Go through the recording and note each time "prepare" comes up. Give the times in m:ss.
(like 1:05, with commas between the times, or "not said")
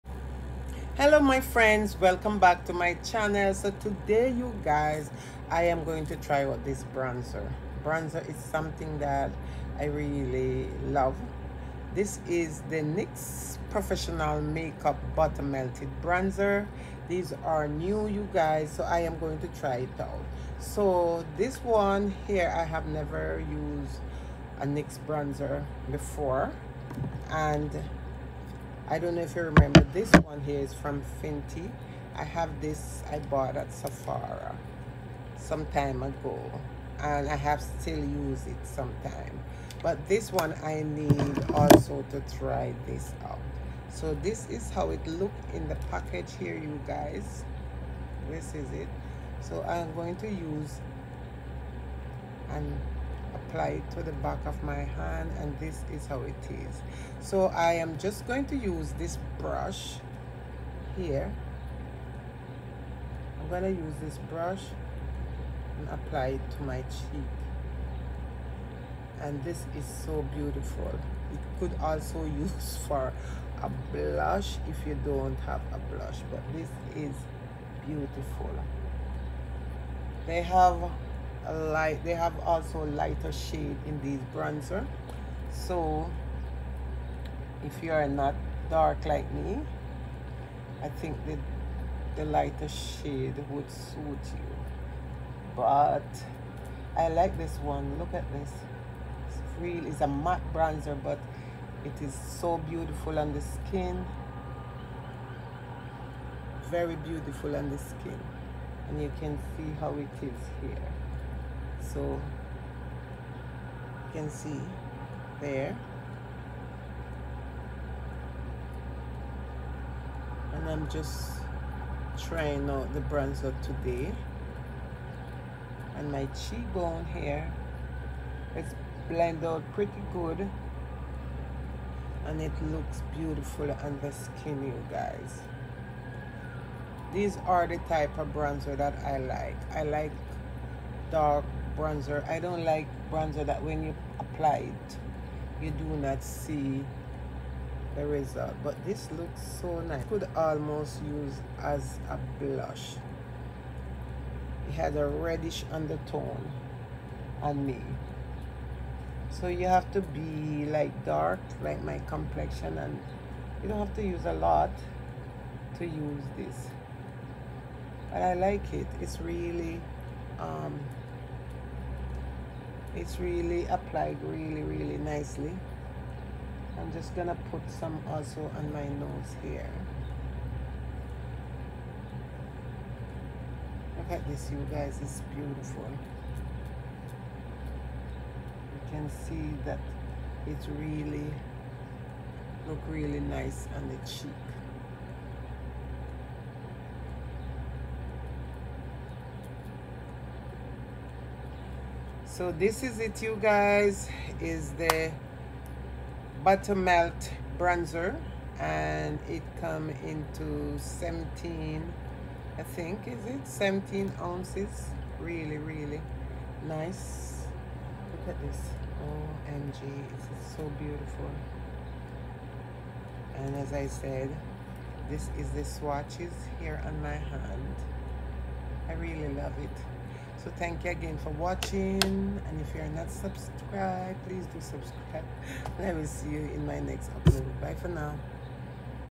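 not said.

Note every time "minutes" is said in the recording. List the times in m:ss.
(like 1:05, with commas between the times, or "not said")
not said.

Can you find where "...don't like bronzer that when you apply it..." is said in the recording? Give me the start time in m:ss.
2:22.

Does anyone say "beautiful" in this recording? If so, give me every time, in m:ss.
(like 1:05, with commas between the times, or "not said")
1:10, 1:17, 1:42, 1:46, 2:13, 3:05, 3:40.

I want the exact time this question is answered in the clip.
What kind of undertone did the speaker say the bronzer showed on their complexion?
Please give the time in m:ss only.
2:35.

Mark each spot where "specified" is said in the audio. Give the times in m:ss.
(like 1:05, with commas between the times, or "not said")
not said.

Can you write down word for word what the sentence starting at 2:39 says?
So you have to be like dark, like my complexion, and you don't have to use a lot to use this.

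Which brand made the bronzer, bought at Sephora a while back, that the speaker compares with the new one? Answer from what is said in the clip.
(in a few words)
Fenty.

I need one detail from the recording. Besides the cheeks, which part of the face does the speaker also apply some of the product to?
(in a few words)
Nose.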